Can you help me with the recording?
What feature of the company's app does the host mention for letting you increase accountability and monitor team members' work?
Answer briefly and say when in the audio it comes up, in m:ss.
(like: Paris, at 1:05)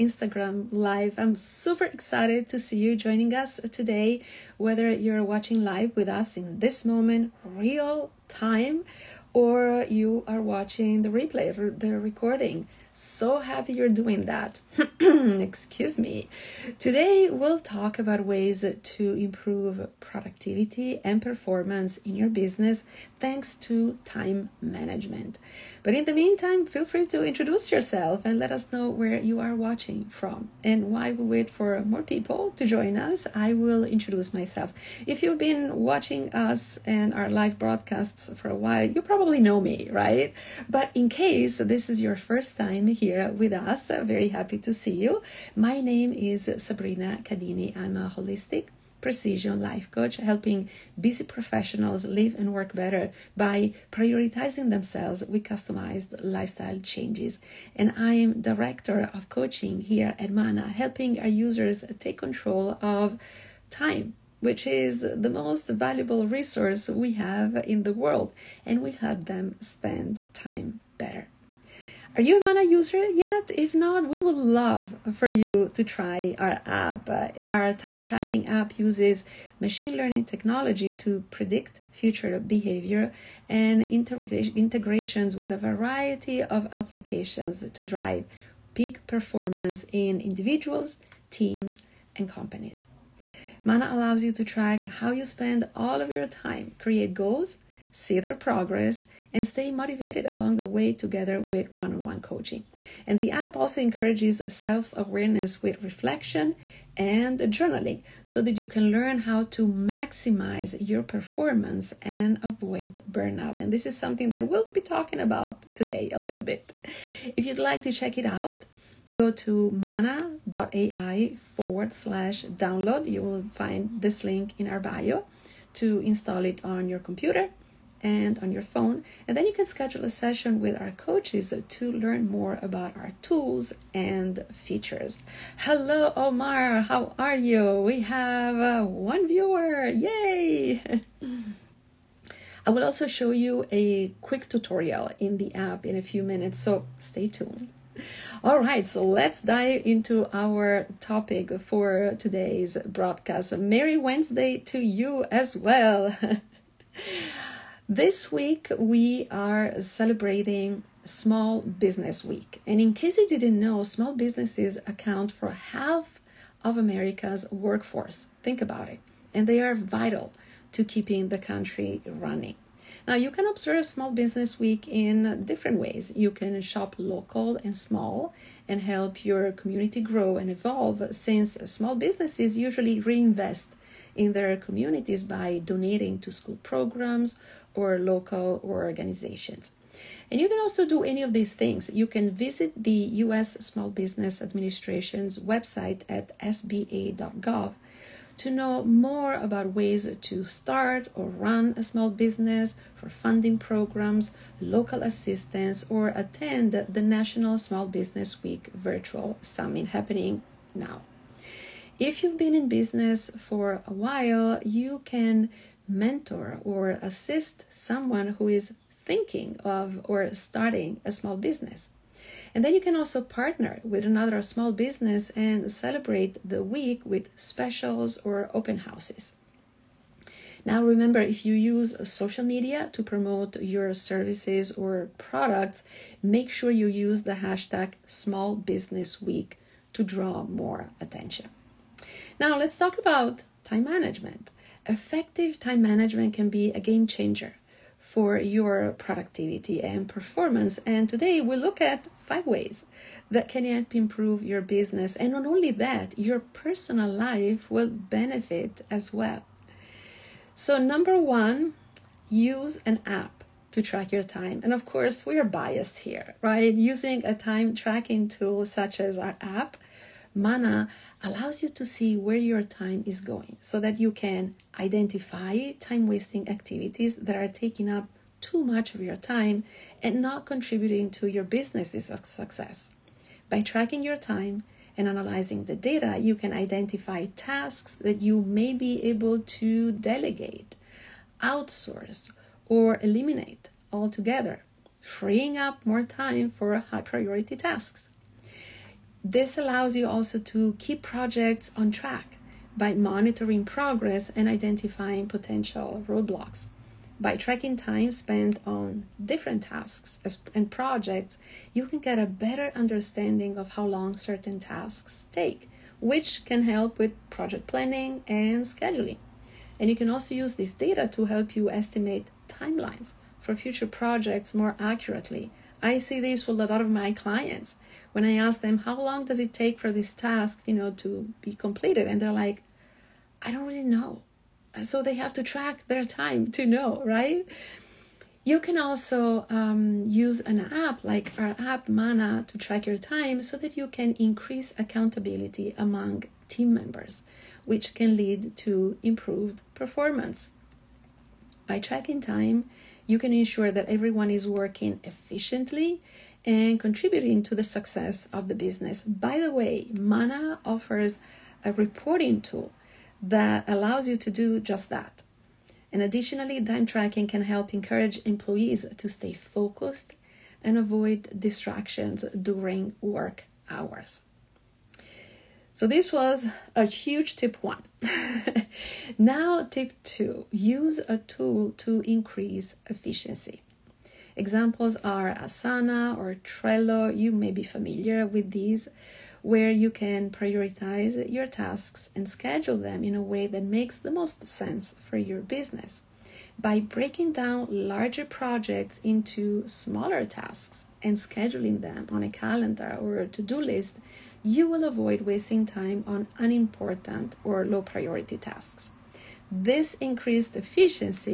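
Reporting tool, at 6:01.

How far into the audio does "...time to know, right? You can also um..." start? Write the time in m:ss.
5:36.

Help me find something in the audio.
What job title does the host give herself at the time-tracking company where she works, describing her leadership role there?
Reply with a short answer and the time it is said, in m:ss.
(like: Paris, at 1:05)
Director of coaching, at 0:58.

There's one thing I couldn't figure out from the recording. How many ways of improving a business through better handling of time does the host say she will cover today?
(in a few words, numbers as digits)
5.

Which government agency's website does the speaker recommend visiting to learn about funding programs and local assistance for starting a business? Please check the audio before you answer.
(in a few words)
U.S. Small Business Administration.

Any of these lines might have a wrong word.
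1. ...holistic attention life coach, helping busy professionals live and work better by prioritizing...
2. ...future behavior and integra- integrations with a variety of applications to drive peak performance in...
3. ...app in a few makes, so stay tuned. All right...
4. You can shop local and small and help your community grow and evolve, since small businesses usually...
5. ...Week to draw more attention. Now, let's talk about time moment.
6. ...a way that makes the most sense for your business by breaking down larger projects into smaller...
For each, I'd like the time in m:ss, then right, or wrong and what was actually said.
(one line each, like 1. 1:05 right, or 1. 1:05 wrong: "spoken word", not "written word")
1. 0:48 wrong: "precision", not "attention"
2. 1:21 right
3. 2:25 wrong: "minutes", not "makes"
4. 2:56 right
5. 3:59 wrong: "management", not "moment"
6. 6:33 right.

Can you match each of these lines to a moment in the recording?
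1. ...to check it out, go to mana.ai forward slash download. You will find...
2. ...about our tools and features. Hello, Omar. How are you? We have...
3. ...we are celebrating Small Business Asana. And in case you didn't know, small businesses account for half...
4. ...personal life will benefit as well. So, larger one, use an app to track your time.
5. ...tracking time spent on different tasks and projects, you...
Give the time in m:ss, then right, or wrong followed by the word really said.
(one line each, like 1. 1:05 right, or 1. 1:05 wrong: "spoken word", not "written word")
1. 1:57 right
2. 2:12 right
3. 2:38 wrong: "Week", not "Asana"
4. 4:16 wrong: "number", not "larger"
5. 5:07 right.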